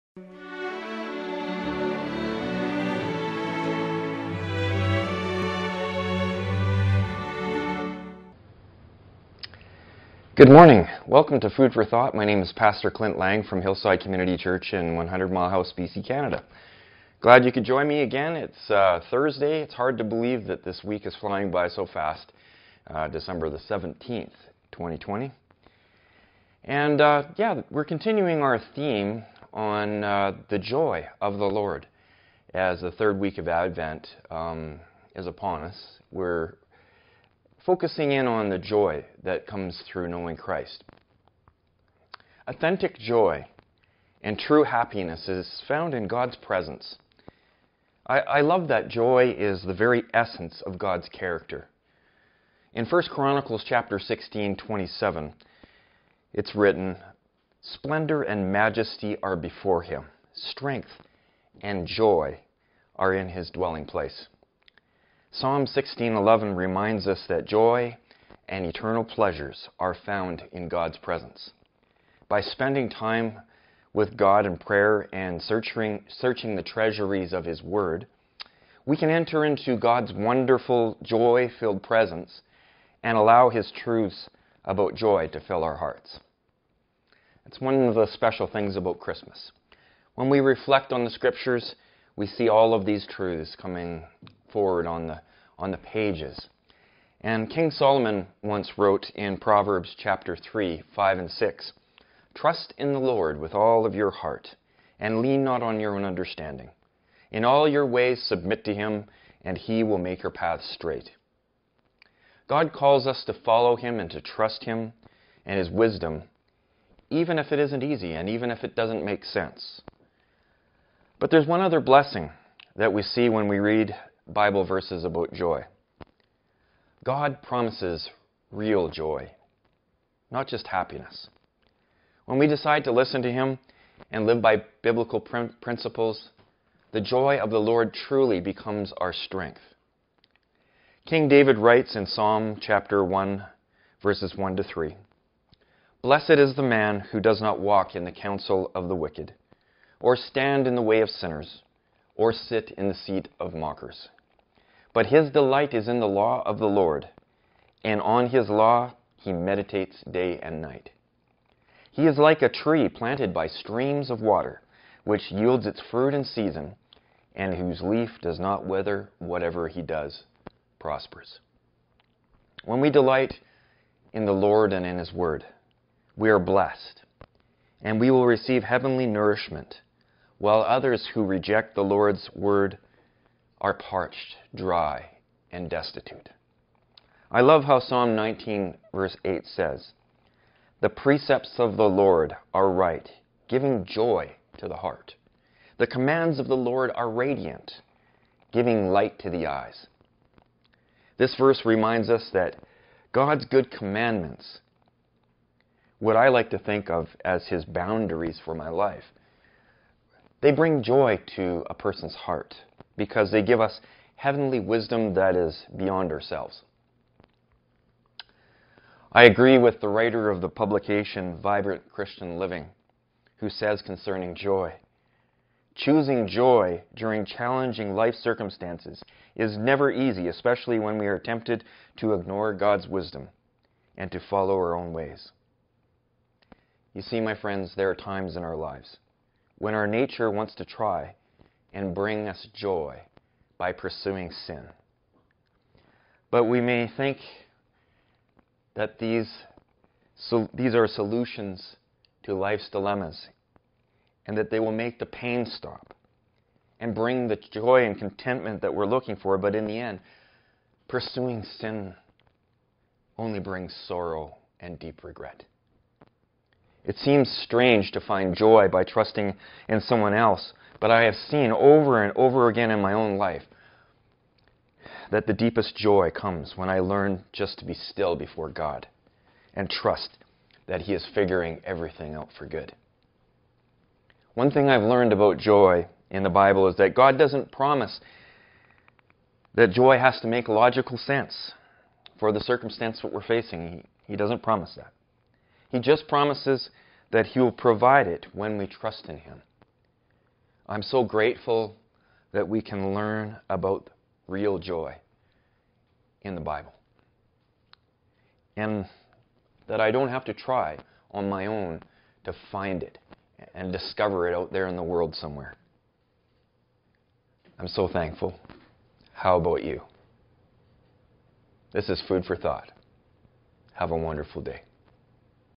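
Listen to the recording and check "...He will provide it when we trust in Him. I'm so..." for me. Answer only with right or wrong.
right.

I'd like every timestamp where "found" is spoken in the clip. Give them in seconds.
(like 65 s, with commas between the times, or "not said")
45 s, 69 s.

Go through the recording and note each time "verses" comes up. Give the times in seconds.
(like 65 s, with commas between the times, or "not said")
124 s, 144 s, 188 s, 201 s.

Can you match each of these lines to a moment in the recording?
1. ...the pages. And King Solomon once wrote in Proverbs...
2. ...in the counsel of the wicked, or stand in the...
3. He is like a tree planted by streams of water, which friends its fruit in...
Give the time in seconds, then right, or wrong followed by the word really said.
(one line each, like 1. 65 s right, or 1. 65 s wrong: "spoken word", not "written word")
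1. 95 s right
2. 147 s right
3. 161 s wrong: "yields", not "friends".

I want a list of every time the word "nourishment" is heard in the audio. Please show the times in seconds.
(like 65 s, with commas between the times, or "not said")
179 s.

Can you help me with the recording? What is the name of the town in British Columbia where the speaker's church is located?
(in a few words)
100 Mile House.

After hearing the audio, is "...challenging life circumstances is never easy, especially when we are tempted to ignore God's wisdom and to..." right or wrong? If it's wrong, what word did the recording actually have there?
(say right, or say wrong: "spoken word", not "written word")
right.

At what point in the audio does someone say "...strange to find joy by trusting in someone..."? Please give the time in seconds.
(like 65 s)
267 s.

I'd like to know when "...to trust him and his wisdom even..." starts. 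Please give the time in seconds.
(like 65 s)
114 s.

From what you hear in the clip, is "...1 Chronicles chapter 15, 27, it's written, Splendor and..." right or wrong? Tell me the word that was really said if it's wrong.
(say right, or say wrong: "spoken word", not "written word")
wrong: "16", not "15".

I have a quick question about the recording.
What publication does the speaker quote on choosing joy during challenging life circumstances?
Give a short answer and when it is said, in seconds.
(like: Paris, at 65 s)
Vibrant Christian Living, at 221 s.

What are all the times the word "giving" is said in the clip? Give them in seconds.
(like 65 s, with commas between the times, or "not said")
193 s, 198 s.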